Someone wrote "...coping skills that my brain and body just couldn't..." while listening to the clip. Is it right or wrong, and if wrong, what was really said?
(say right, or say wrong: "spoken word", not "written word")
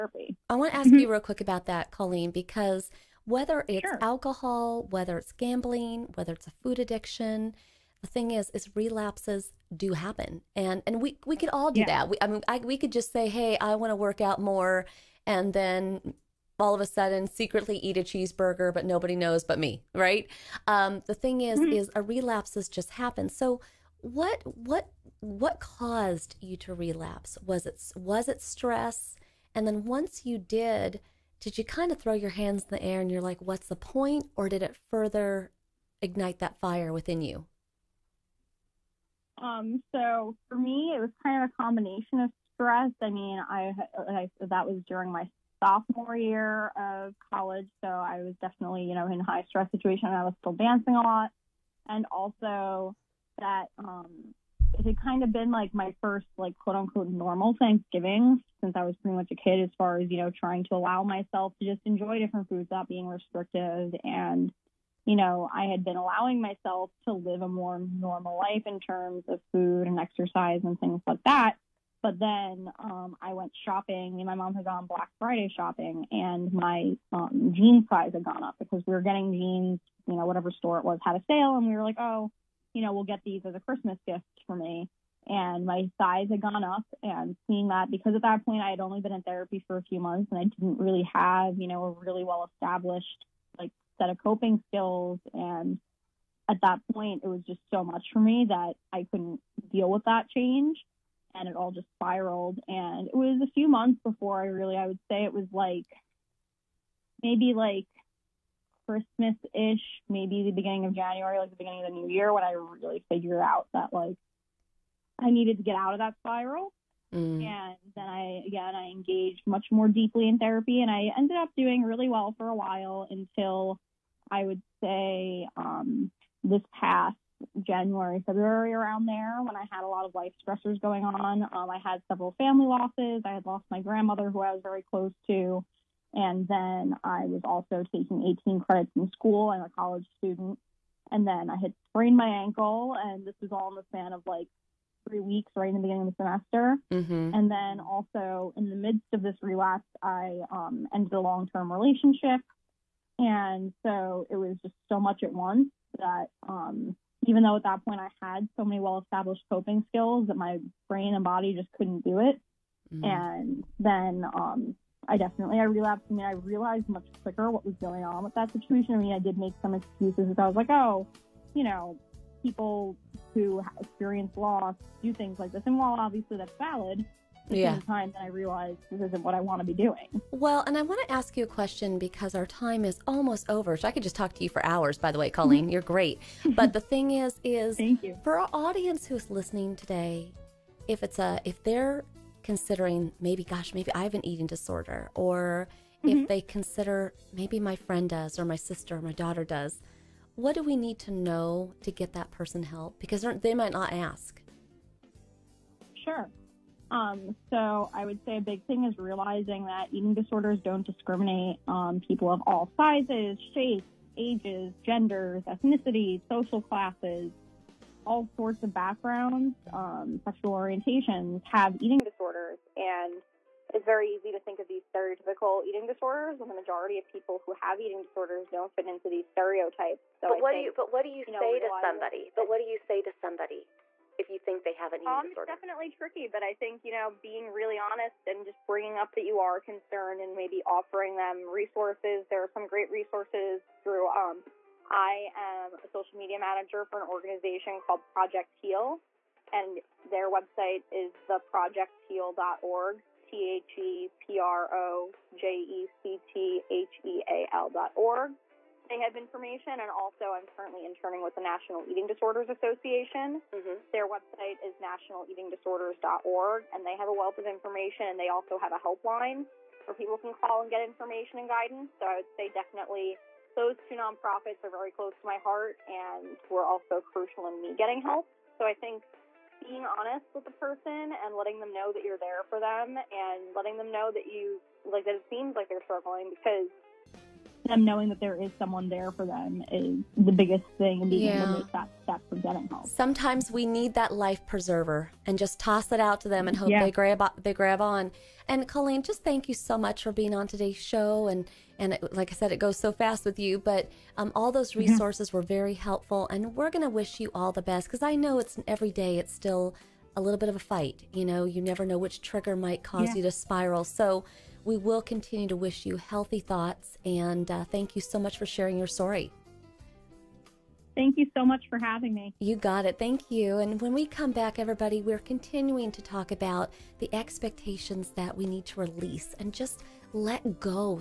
right.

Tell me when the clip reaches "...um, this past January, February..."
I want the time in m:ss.
2:05.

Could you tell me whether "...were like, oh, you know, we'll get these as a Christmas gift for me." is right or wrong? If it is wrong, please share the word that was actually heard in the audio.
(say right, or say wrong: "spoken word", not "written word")
right.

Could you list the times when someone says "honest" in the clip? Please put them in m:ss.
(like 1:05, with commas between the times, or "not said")
3:57, 4:39.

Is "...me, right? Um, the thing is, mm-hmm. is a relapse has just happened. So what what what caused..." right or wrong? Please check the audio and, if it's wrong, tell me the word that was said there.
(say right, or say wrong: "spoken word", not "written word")
right.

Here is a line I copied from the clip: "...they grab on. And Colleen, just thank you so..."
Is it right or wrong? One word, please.
right.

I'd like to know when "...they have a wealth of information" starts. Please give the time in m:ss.
4:26.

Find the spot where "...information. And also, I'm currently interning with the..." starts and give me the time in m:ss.
4:19.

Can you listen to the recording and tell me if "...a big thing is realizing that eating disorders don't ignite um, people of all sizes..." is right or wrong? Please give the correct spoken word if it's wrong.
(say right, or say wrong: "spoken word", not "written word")
wrong: "discriminate", not "ignite".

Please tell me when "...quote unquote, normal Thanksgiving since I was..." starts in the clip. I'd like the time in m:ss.
0:56.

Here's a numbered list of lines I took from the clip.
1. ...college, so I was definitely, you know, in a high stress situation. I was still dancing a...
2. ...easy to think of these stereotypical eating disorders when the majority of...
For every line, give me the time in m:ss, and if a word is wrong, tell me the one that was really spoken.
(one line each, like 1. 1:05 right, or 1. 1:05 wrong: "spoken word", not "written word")
1. 0:47 right
2. 3:44 right.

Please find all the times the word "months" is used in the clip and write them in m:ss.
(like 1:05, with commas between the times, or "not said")
1:30, 1:43.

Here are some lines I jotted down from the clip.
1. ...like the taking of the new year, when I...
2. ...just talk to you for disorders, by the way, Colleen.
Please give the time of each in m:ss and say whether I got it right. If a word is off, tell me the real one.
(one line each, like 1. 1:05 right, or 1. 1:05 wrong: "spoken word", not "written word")
1. 1:51 wrong: "beginning", not "taking"
2. 3:04 wrong: "hours", not "disorders".